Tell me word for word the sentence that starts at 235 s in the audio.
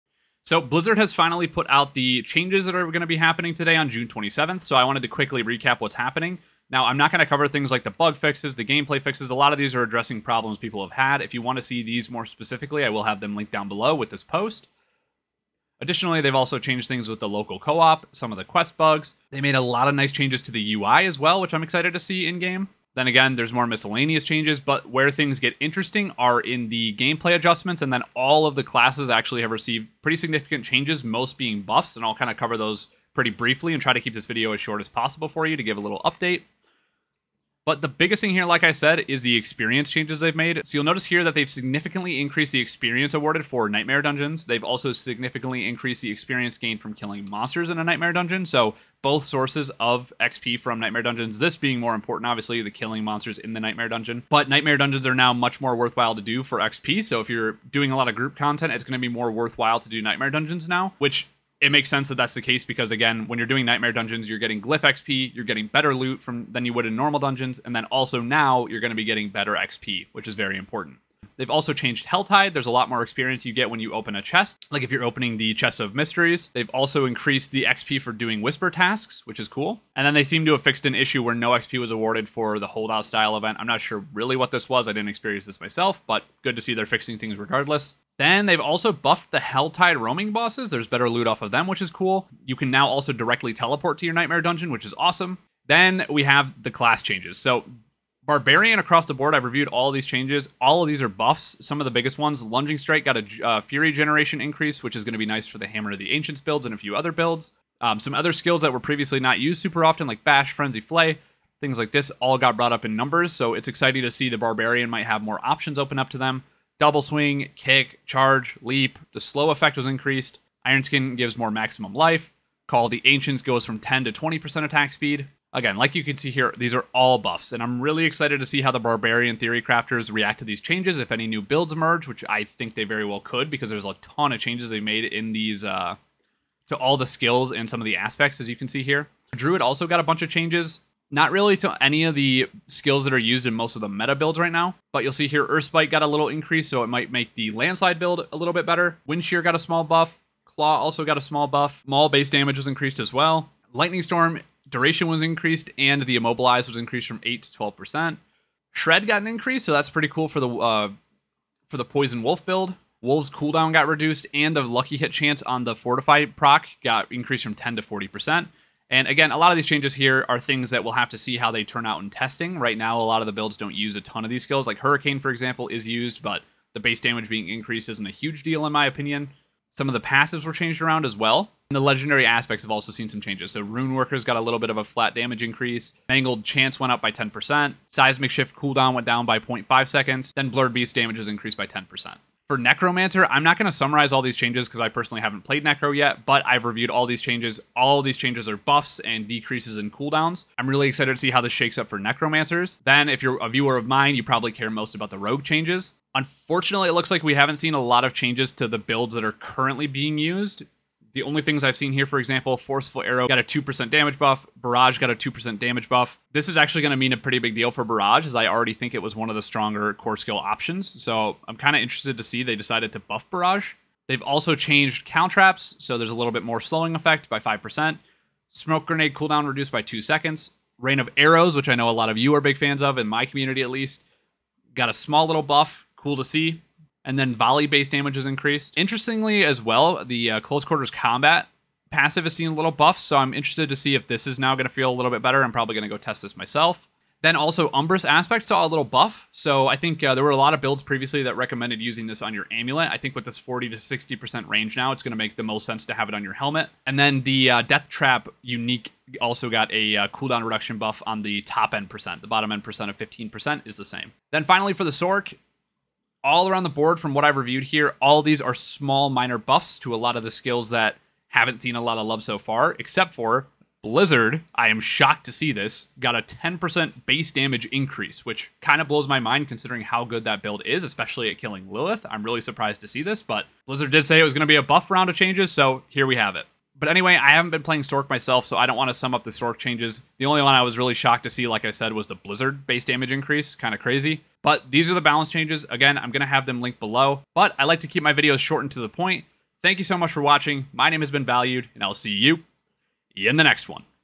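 Cool to see and then volley based damage is increased.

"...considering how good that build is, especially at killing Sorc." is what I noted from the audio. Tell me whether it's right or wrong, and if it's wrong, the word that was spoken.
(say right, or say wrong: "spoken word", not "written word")
wrong: "Lilith", not "Sorc".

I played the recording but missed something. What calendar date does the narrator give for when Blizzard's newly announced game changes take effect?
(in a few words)
June 27th.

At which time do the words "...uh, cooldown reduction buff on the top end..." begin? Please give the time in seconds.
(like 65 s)
259 s.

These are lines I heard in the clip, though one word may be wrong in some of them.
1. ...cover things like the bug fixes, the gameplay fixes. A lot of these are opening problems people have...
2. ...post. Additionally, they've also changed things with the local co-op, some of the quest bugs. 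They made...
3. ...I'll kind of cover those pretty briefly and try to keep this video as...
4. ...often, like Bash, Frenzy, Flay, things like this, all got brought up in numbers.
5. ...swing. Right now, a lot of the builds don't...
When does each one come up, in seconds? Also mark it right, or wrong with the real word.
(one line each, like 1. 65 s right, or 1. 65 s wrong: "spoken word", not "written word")
1. 7 s wrong: "addressing", not "opening"
2. 14 s right
3. 32 s right
4. 109 s right
5. 172 s wrong: "testing", not "swing".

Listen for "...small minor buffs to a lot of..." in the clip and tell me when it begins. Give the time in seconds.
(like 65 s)
268 s.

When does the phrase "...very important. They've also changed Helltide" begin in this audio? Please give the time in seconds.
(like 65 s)
70 s.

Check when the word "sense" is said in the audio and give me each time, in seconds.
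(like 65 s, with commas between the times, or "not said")
61 s, 255 s.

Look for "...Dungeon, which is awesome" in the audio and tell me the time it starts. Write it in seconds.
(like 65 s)
94 s.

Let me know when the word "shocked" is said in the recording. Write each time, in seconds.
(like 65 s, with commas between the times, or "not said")
274 s, 290 s.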